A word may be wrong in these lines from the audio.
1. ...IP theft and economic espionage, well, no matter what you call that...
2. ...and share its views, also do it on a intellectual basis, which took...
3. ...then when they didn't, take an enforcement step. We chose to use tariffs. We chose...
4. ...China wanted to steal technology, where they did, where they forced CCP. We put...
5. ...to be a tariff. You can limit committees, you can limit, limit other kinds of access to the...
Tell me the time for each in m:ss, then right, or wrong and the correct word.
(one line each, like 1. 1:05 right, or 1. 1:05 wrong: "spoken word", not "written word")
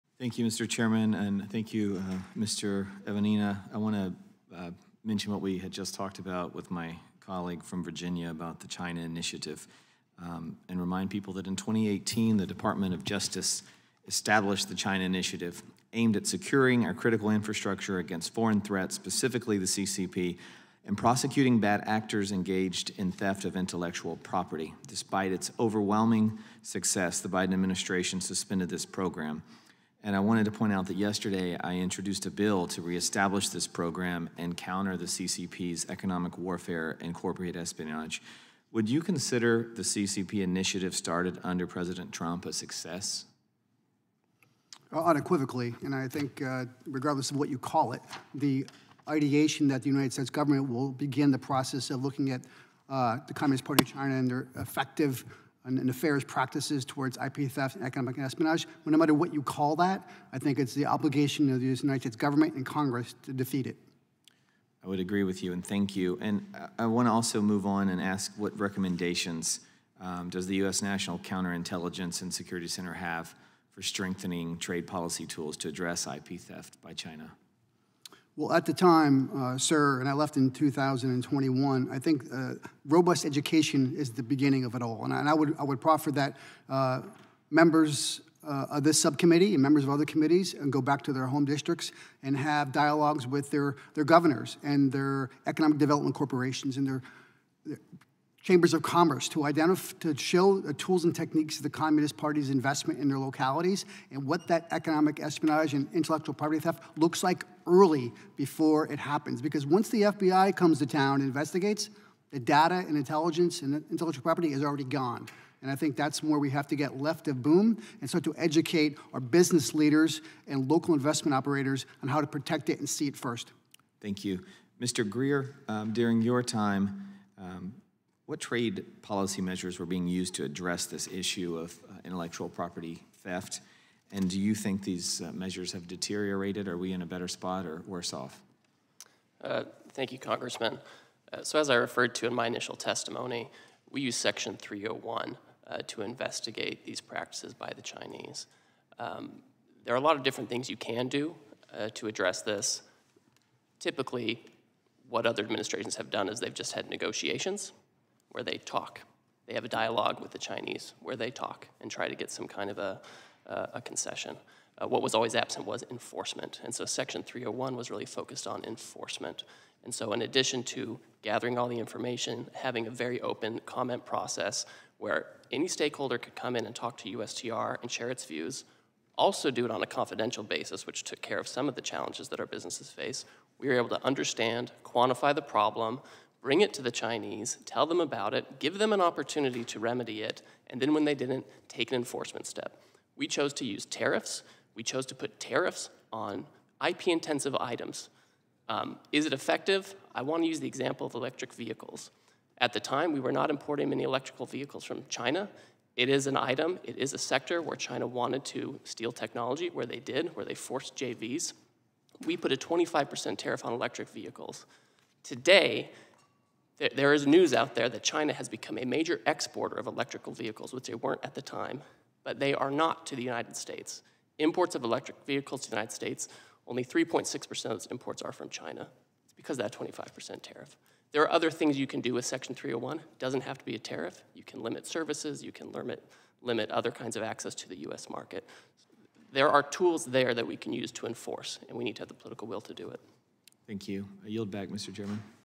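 1. 0:57 right
2. 2:57 wrong: "confidential", not "intellectual"
3. 3:10 right
4. 3:27 wrong: "JVs", not "CCP"
5. 3:53 wrong: "services", not "committees".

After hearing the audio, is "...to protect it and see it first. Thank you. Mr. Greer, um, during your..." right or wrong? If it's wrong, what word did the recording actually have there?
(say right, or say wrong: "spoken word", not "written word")
right.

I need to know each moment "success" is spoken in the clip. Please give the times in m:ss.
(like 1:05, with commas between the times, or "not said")
0:26, 0:42.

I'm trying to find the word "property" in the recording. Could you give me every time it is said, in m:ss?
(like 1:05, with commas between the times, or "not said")
0:24, 1:46, 1:54, 2:12.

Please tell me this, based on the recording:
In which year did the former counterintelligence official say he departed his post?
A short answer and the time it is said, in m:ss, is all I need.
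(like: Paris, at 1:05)
2021, at 1:20.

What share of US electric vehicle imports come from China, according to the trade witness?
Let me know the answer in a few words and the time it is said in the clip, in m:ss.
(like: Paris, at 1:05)
3.6%, at 3:46.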